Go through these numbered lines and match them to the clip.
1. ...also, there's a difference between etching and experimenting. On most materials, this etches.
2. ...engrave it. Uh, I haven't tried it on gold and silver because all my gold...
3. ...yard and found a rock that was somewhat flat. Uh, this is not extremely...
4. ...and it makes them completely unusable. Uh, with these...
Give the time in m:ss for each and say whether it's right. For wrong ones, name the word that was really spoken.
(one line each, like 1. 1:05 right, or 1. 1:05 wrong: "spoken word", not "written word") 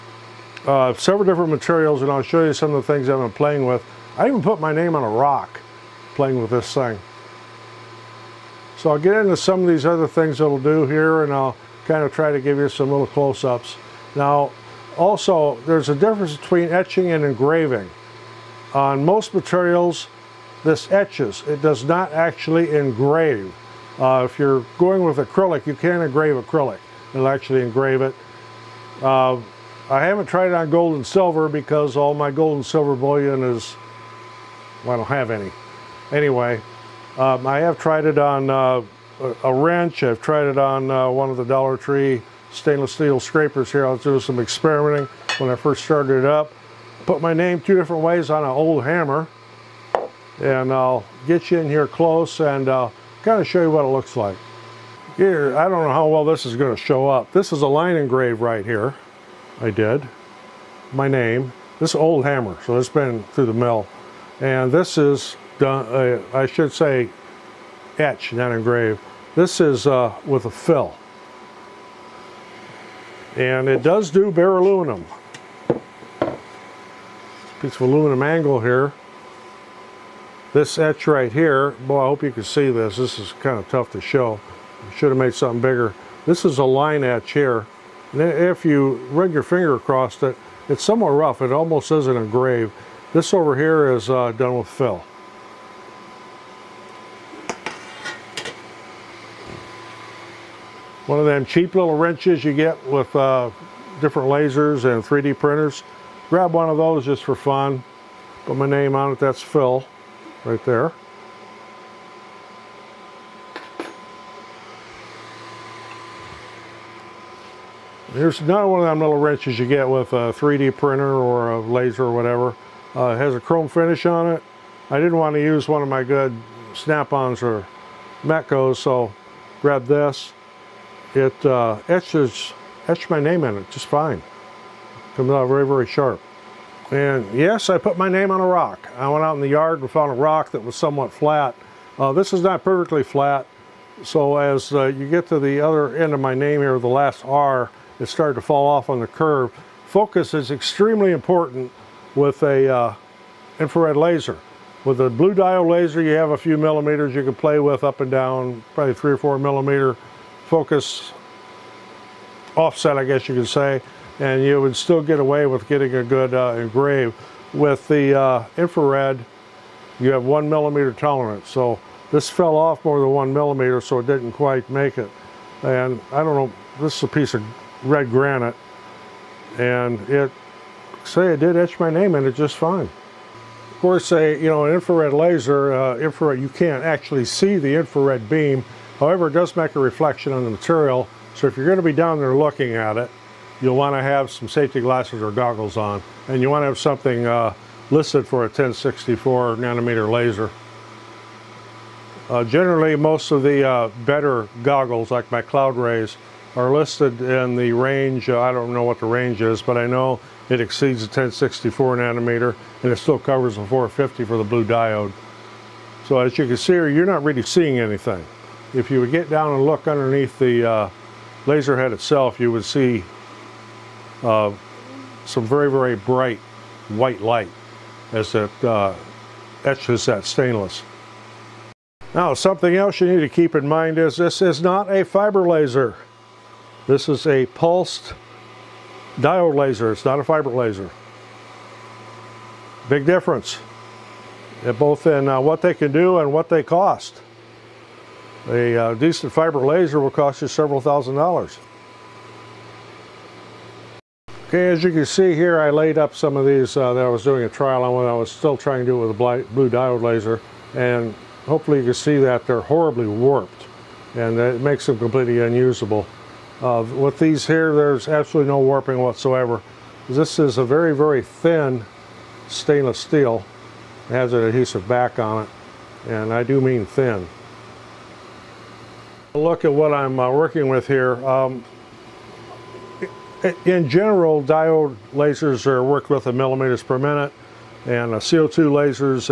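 1. 0:14 wrong: "engraving", not "experimenting"
2. 0:27 right
3. 2:19 wrong: "perfectly", not "extremely"
4. 4:24 right.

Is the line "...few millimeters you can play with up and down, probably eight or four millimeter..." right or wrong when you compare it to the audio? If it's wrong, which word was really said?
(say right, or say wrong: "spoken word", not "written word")
wrong: "three", not "eight".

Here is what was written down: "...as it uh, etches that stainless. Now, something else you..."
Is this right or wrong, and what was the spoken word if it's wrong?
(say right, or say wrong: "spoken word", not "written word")
right.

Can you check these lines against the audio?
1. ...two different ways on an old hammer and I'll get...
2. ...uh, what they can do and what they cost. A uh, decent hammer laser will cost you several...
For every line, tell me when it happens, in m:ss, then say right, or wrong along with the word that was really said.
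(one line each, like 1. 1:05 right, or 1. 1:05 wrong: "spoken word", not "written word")
1. 0:47 right
2. 4:05 wrong: "fiber", not "hammer".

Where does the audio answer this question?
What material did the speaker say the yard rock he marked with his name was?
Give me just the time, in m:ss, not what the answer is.
2:57.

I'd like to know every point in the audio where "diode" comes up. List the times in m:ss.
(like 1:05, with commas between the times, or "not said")
2:35, 3:34, 3:59, 4:19, 4:44.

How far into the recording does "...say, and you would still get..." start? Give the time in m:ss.
2:43.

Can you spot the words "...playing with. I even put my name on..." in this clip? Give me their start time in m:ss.
0:03.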